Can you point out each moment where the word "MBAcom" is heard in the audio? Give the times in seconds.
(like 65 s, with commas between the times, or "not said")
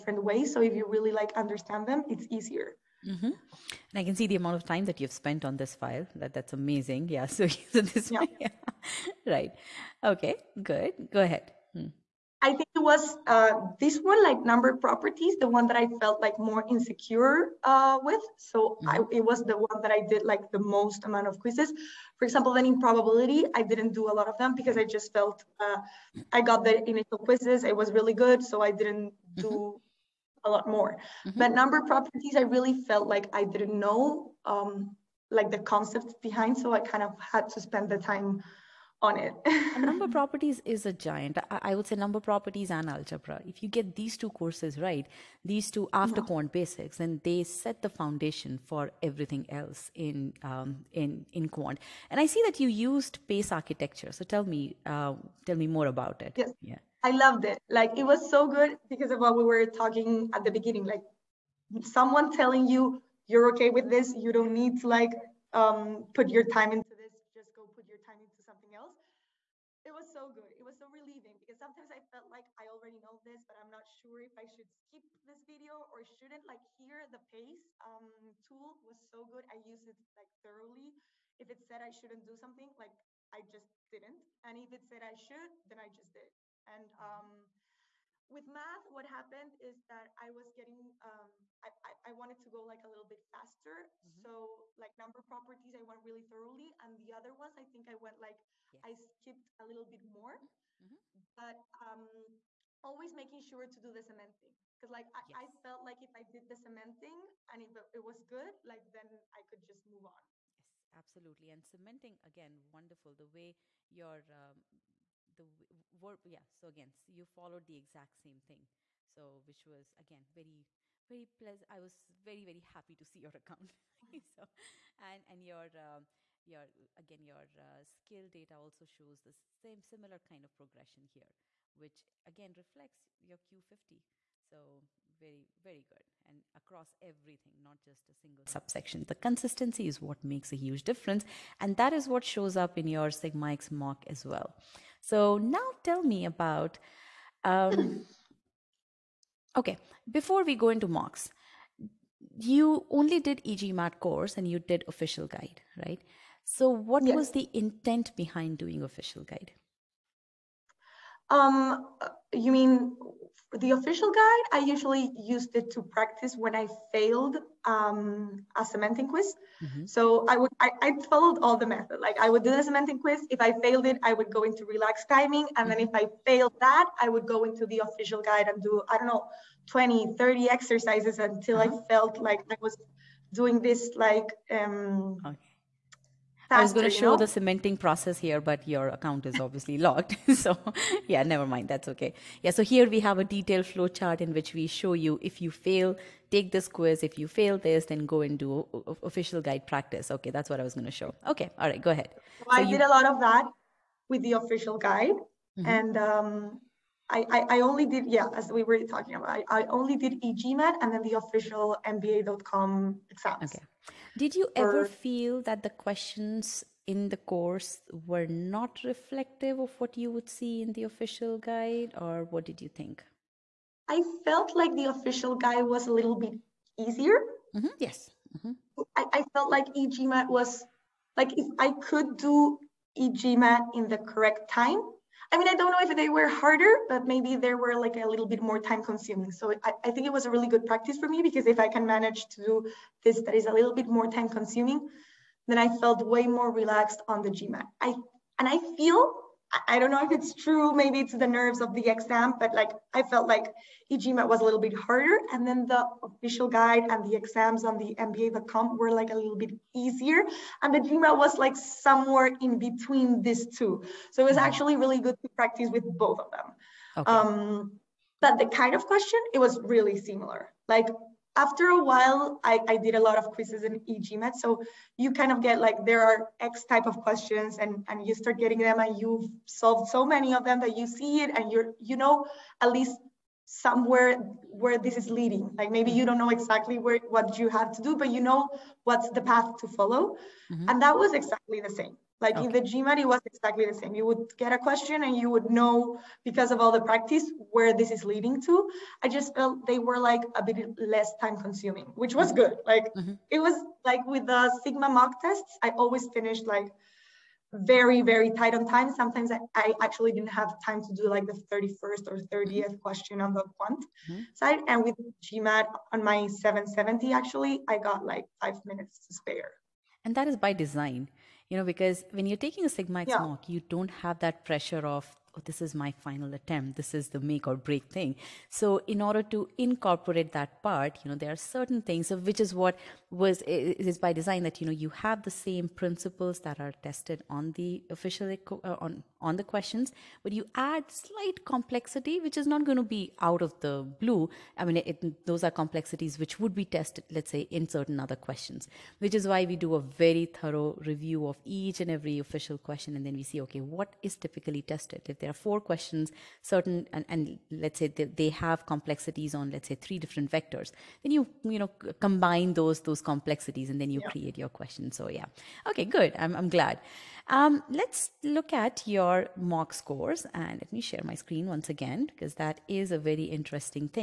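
211 s, 257 s.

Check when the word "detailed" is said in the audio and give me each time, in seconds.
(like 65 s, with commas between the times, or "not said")
193 s.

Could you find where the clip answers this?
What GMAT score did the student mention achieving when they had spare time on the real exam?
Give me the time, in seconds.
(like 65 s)
316 s.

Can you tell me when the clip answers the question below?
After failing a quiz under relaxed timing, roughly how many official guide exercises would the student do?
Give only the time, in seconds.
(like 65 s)
179 s.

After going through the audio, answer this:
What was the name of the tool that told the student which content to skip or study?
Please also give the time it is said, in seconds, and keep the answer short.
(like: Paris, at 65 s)
Pace architecture, at 53 s.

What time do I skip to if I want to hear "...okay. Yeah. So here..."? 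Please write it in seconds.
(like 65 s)
191 s.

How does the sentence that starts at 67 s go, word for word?
Just go put your time into something else.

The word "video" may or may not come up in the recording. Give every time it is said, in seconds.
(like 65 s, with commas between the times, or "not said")
75 s.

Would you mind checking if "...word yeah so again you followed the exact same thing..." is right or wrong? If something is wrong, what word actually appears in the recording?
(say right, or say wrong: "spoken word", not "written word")
right.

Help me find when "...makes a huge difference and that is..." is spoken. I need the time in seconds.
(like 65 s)
140 s.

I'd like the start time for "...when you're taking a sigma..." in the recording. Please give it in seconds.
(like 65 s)
322 s.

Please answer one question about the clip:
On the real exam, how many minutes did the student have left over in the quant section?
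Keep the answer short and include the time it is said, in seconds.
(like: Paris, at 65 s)
5 minutes, at 318 s.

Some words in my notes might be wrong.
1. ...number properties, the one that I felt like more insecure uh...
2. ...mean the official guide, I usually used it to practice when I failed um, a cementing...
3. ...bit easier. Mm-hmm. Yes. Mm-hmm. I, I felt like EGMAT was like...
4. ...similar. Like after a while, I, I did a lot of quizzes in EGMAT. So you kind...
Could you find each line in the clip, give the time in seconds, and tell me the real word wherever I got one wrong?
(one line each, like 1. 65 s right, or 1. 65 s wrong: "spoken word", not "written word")
1. 14 s right
2. 162 s right
3. 226 s right
4. 269 s right.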